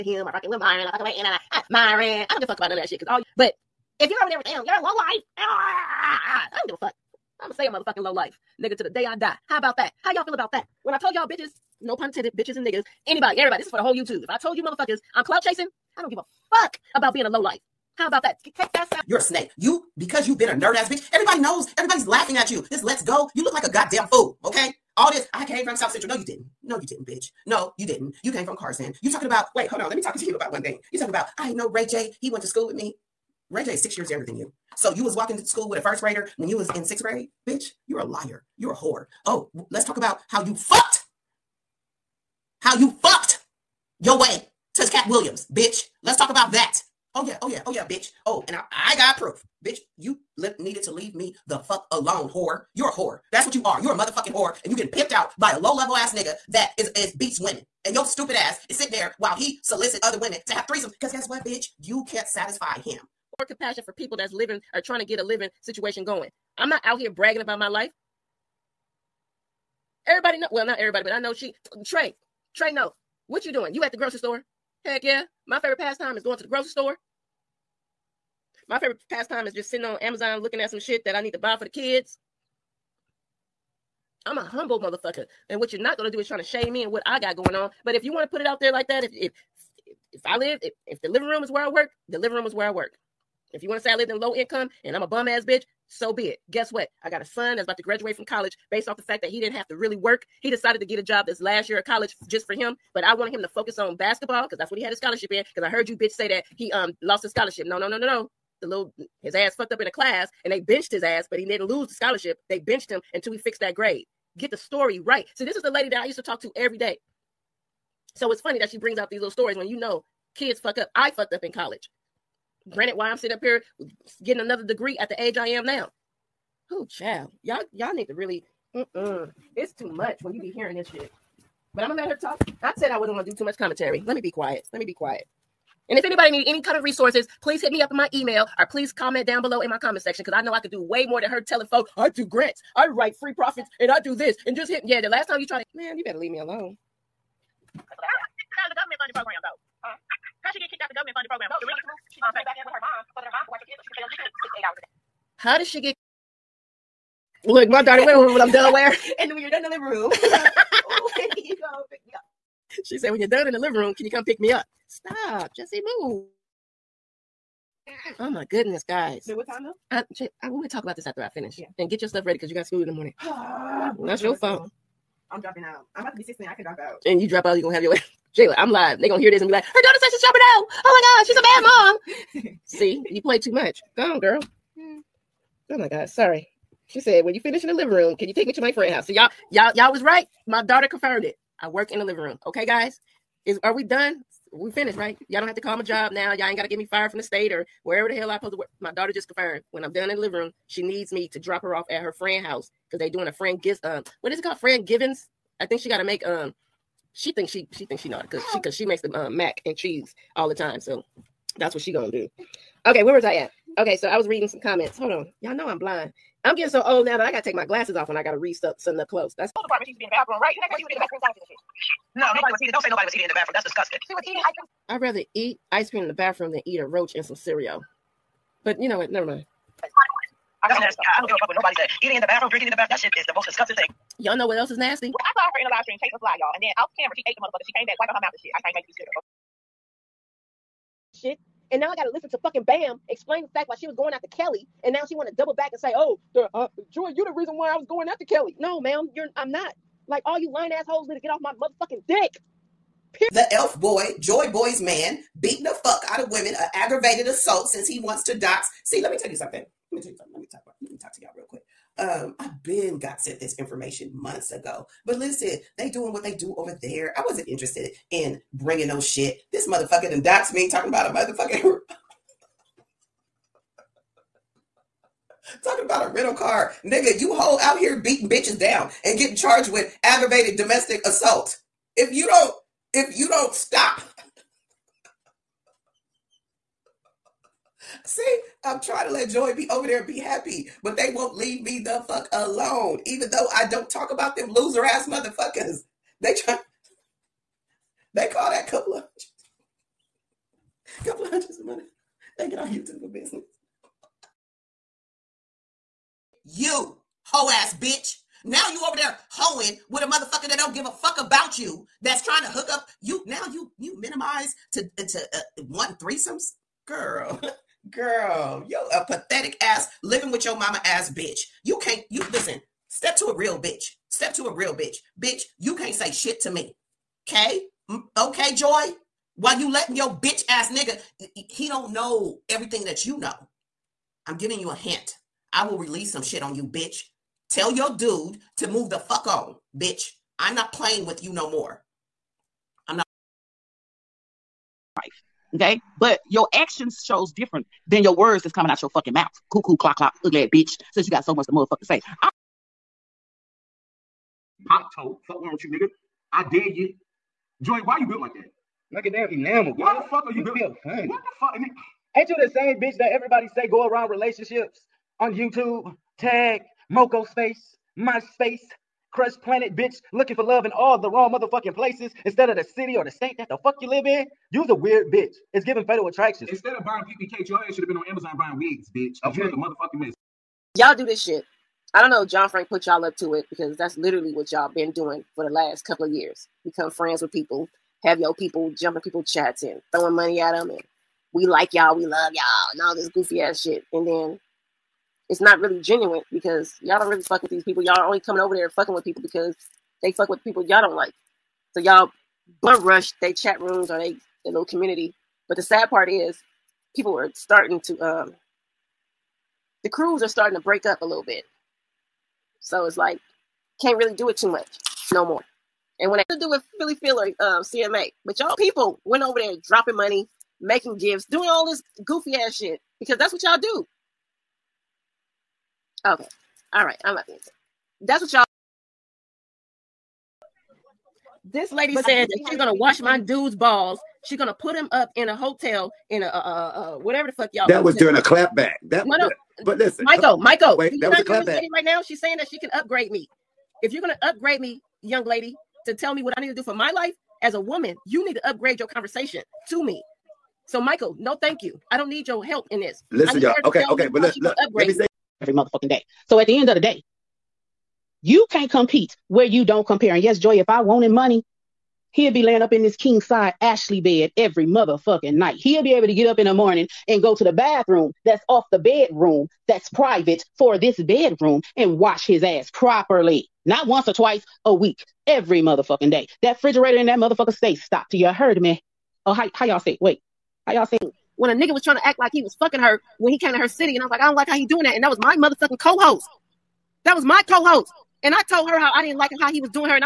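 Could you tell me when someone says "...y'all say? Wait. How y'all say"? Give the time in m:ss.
7:59.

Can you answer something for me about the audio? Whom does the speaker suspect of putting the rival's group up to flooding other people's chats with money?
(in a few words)
John Frank.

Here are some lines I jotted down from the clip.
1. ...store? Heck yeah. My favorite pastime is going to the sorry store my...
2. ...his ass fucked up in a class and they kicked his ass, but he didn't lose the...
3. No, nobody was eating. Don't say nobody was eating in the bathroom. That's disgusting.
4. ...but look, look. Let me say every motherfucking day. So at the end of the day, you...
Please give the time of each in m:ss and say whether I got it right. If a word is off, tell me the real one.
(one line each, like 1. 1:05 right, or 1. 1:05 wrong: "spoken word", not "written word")
1. 1:14 wrong: "grocery", not "sorry"
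2. 1:49 wrong: "benched", not "kicked"
3. 3:42 right
4. 7:34 right.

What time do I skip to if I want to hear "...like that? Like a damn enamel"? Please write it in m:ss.
5:58.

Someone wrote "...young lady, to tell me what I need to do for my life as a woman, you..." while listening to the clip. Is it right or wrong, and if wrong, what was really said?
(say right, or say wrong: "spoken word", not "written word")
right.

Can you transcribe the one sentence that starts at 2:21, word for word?
I do grants, I write free profits, and I do this.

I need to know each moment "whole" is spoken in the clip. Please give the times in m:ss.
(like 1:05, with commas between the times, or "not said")
0:13, 4:37.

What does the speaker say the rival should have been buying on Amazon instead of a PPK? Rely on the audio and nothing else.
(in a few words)
Wigs.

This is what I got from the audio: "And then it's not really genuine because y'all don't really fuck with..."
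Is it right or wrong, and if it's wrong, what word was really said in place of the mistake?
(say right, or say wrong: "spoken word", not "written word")
right.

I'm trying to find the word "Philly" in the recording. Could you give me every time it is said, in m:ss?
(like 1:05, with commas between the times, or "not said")
6:56.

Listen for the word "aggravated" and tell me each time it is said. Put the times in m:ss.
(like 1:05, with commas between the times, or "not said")
4:16, 4:40.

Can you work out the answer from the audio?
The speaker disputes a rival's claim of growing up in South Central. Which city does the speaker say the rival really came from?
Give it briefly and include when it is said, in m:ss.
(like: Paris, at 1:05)
Carson, at 0:28.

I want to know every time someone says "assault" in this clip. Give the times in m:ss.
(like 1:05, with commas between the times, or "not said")
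4:17, 4:41.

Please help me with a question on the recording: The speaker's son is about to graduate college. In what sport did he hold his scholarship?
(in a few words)
Basketball.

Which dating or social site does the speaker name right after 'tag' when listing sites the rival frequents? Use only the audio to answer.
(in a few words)
Moco Space.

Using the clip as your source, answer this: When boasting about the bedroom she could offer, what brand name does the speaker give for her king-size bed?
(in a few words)
Ashley.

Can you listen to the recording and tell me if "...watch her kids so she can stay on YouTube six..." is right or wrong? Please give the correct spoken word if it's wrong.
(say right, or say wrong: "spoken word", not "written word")
right.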